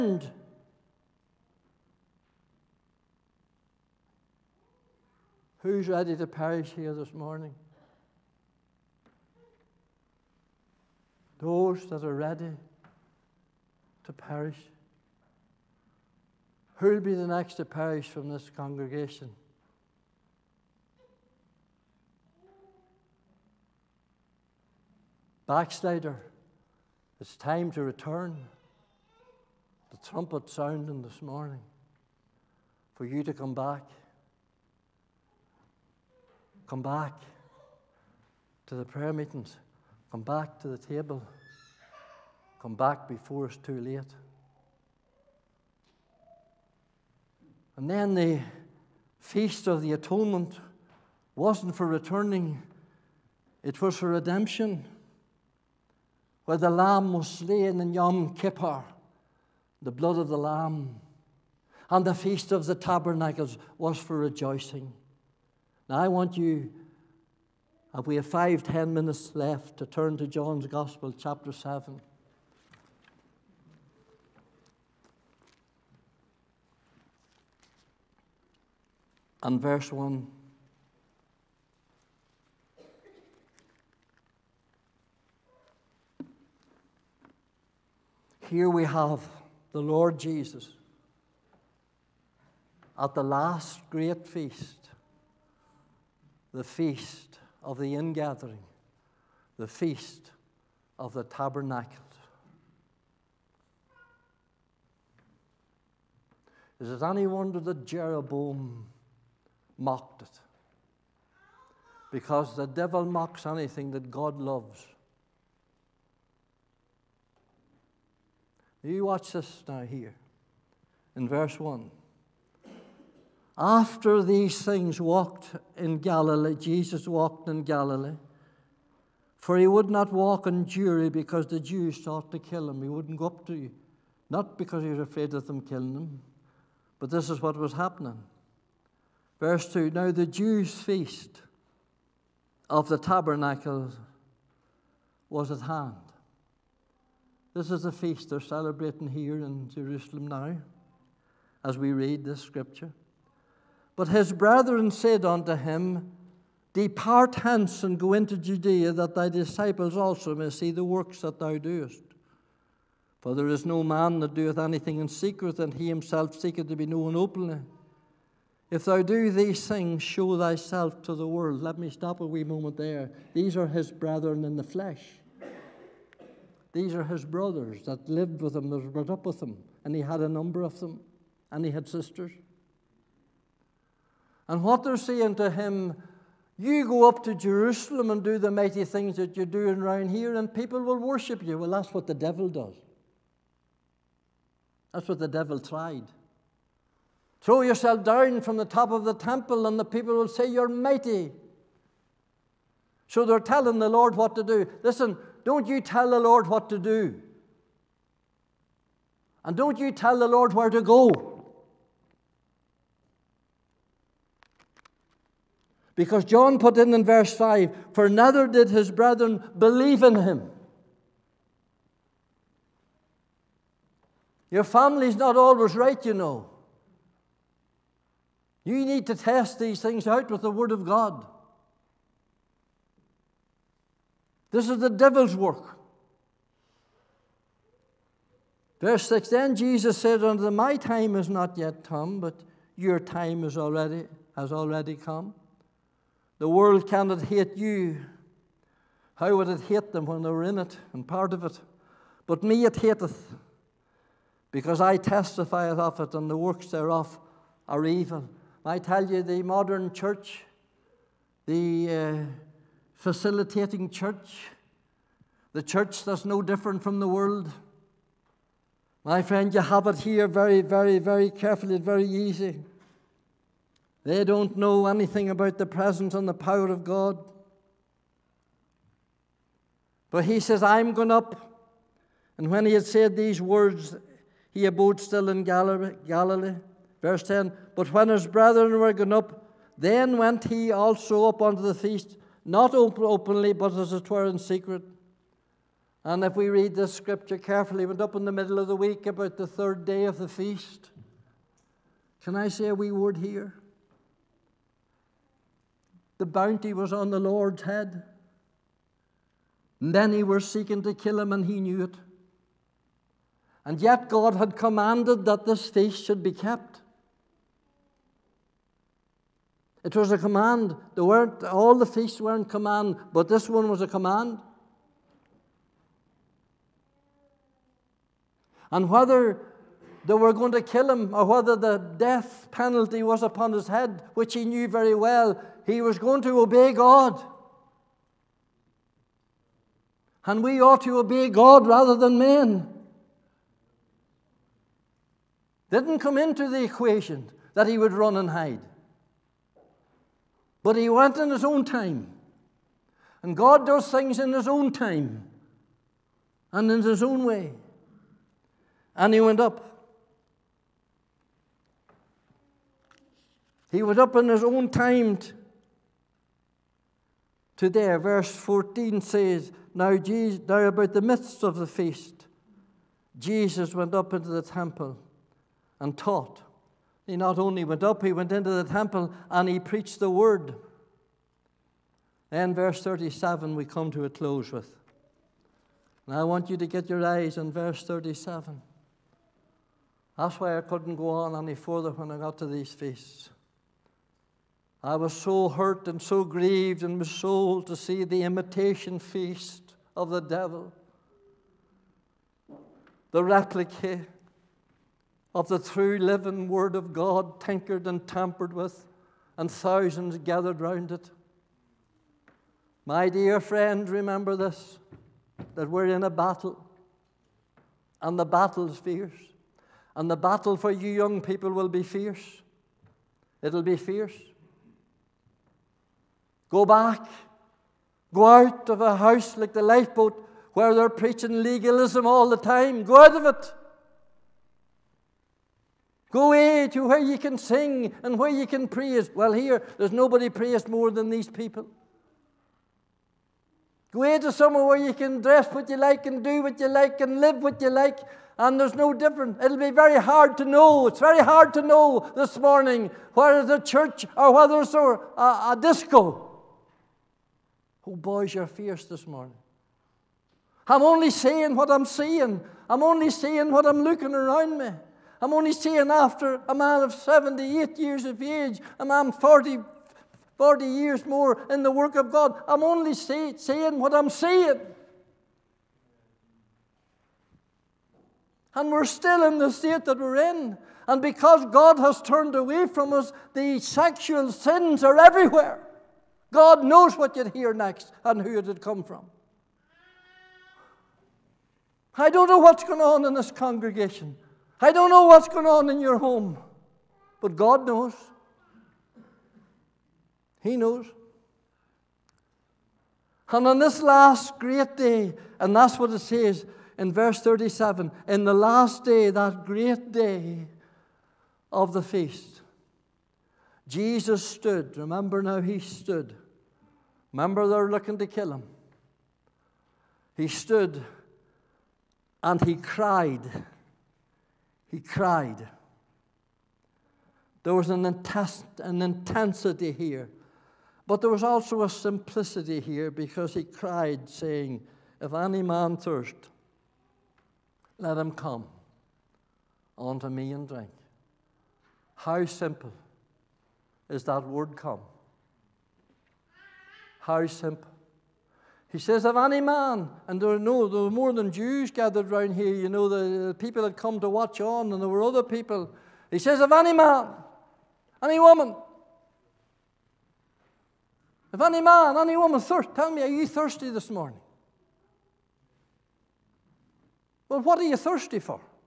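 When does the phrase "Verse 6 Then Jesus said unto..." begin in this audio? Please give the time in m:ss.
3:58.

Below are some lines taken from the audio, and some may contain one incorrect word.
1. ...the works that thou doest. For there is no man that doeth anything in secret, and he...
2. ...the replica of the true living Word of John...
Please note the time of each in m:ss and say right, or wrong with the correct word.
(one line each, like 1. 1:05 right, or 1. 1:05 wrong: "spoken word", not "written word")
1. 2:40 right
2. 6:43 wrong: "God", not "John".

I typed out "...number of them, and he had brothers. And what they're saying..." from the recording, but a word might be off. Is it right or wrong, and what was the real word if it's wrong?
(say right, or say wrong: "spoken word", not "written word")
wrong: "sisters", not "brothers".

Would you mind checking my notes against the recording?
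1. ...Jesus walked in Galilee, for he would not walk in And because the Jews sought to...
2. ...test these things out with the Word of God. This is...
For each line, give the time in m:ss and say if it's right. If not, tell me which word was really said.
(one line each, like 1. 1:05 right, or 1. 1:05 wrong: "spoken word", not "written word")
1. 2:06 wrong: "Jewry", not "And"
2. 3:49 right.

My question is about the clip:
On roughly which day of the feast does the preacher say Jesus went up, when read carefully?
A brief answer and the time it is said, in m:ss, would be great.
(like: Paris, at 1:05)
third day, at 4:59.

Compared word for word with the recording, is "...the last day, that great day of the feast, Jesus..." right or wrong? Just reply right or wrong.
right.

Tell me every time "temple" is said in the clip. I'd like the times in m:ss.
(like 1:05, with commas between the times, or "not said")
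3:19, 6:14, 6:18.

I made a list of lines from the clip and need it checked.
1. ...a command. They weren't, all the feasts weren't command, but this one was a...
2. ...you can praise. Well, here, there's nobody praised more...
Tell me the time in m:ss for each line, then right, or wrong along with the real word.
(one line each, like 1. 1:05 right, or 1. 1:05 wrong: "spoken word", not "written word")
1. 5:20 right
2. 7:18 right.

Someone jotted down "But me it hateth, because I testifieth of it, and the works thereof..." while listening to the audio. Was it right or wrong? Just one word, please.
right.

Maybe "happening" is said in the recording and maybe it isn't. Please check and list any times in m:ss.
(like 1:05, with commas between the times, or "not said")
2:17.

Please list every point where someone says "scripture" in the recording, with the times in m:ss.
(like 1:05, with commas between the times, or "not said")
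2:32, 4:56.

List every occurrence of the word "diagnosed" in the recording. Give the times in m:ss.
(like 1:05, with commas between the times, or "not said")
not said.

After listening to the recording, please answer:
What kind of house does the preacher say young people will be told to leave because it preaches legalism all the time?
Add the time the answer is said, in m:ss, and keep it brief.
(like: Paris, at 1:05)
the lifeboat, at 7:09.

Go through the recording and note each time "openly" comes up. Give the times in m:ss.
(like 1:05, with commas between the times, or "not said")
2:47, 4:52.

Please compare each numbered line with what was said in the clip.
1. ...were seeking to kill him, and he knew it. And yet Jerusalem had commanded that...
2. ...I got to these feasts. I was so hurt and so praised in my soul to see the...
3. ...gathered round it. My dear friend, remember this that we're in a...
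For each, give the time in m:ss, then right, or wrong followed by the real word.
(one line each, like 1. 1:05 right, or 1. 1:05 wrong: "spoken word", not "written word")
1. 5:10 wrong: "God", not "Jerusalem"
2. 6:32 wrong: "grieved", not "praised"
3. 6:50 right.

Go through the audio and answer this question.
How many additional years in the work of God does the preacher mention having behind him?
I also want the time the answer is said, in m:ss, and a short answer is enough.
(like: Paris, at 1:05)
40, at 7:50.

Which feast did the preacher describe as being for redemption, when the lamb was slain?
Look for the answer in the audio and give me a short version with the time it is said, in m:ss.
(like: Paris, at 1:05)
Yom Kippur, at 0:57.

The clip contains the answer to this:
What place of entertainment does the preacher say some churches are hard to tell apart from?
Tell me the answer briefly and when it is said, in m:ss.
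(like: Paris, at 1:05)
a disco, at 7:35.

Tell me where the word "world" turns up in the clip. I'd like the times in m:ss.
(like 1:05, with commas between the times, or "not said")
2:51, 4:06, 4:27.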